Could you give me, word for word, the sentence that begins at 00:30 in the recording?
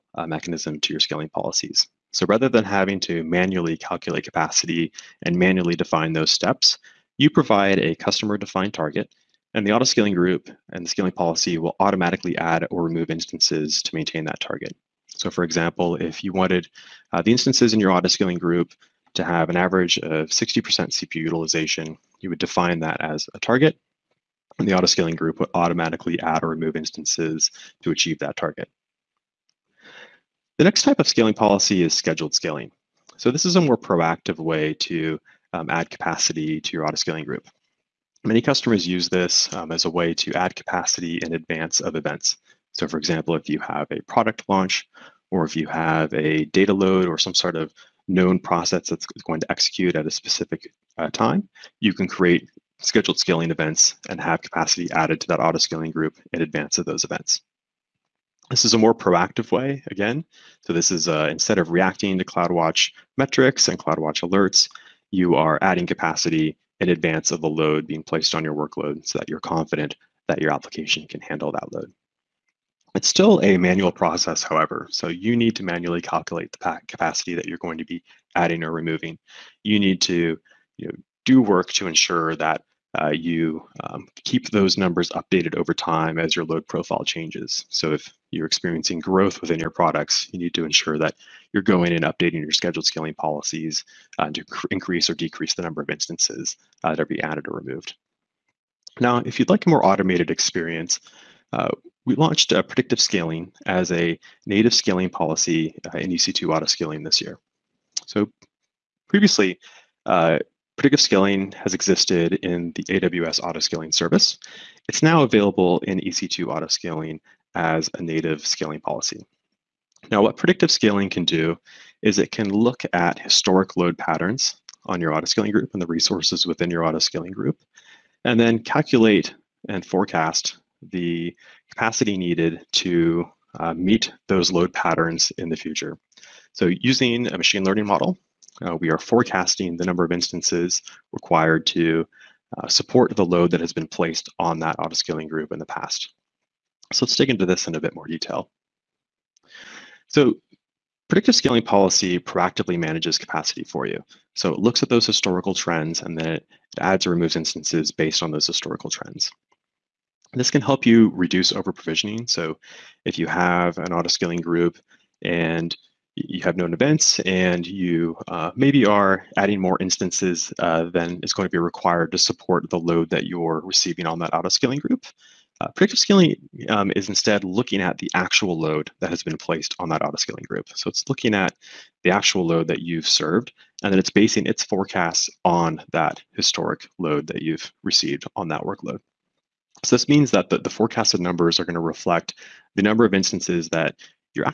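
The next type of scaling policy is scheduled scaling.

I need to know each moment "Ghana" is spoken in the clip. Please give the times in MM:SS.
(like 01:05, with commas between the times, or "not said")
not said.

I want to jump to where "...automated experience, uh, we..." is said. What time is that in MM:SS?
01:39.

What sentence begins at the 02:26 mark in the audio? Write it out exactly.
So let's dig into this in a bit more detail.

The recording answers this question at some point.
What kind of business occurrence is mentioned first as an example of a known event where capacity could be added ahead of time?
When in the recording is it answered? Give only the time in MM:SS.
00:44.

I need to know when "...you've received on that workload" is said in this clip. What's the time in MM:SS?
03:07.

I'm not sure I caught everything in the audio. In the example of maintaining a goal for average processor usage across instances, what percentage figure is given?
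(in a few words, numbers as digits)
60%.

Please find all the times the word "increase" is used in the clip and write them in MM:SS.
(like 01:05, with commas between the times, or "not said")
01:34.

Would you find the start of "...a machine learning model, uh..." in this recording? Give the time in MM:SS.
02:17.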